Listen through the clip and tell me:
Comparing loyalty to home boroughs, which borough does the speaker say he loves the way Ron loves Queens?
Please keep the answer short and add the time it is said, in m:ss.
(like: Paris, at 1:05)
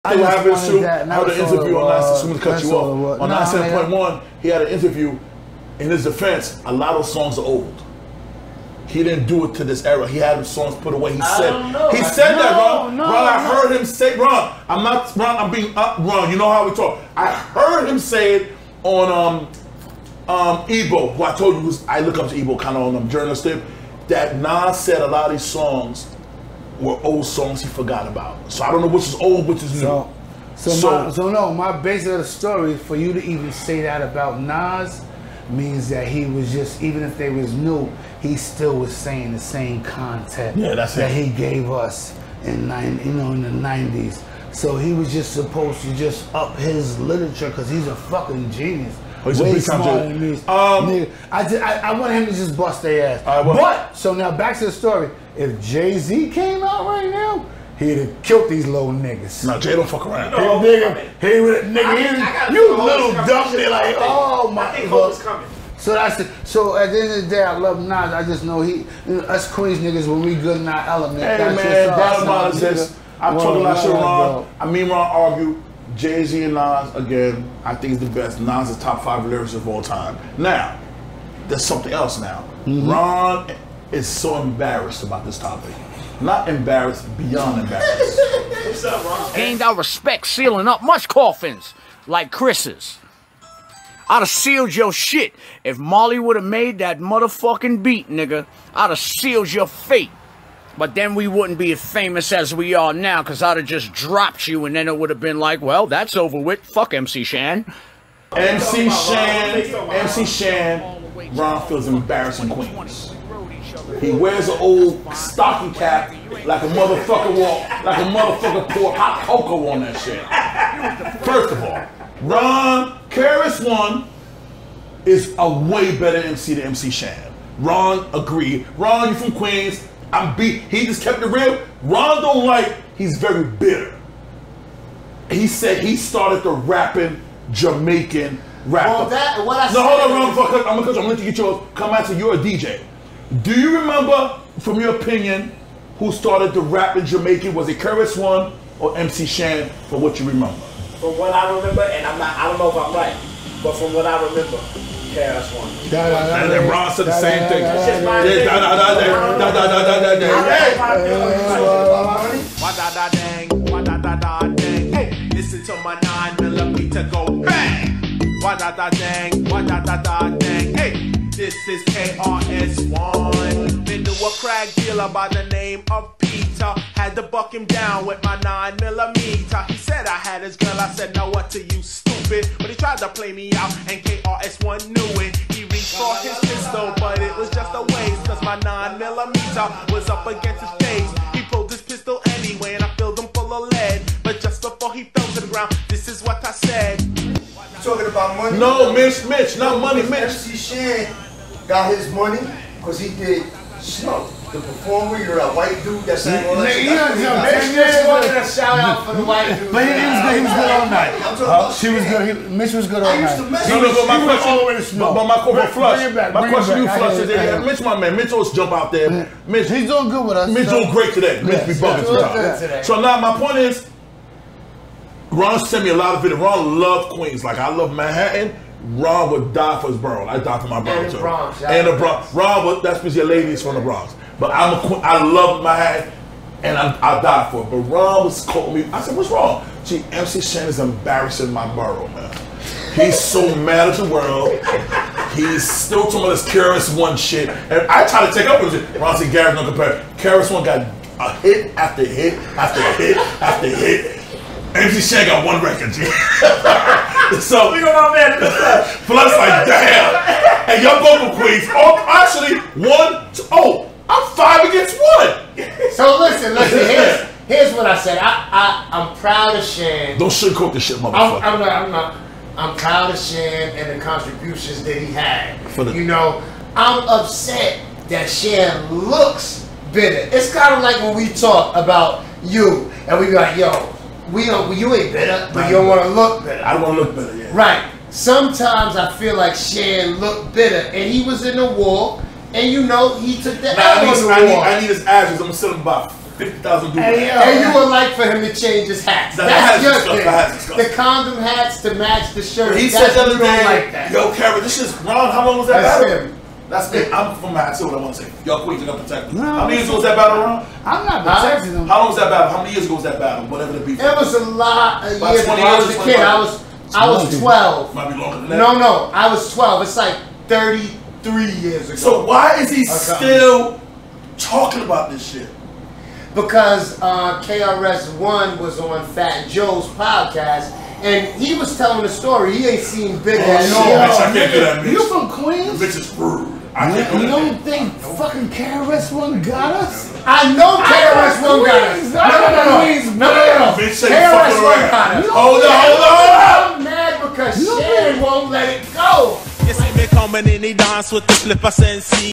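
Manhattan, at 3:47.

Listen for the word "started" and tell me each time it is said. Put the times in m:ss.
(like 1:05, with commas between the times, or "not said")
2:15, 2:26.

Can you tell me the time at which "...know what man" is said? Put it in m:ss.
4:17.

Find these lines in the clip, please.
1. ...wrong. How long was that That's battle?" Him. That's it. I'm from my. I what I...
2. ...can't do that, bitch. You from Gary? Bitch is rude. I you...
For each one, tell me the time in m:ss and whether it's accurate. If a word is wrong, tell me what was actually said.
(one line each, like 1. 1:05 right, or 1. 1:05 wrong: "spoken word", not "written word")
1. 5:05 right
2. 5:34 wrong: "Queens", not "Gary".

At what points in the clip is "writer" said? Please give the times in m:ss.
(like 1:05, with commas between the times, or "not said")
not said.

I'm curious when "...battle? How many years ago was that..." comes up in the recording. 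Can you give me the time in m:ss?
5:12.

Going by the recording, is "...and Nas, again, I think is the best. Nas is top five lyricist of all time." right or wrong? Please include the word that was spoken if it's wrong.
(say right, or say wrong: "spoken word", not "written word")
right.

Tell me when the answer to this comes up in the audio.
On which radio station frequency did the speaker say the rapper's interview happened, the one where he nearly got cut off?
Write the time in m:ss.
0:03.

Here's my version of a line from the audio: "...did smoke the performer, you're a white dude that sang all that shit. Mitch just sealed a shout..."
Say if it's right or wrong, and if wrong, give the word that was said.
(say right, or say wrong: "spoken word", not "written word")
wrong: "wanted", not "sealed".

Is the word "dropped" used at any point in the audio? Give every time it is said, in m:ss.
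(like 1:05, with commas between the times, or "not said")
1:43.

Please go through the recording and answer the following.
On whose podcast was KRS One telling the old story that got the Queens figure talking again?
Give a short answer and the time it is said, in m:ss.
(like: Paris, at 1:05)
Fat Joe, at 5:29.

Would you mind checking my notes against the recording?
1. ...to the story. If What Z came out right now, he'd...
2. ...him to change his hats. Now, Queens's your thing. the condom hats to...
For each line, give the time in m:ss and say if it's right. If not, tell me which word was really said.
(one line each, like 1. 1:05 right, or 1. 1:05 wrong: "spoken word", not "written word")
1. 0:54 wrong: "Jay", not "What"
2. 4:58 wrong: "That", not "Queens".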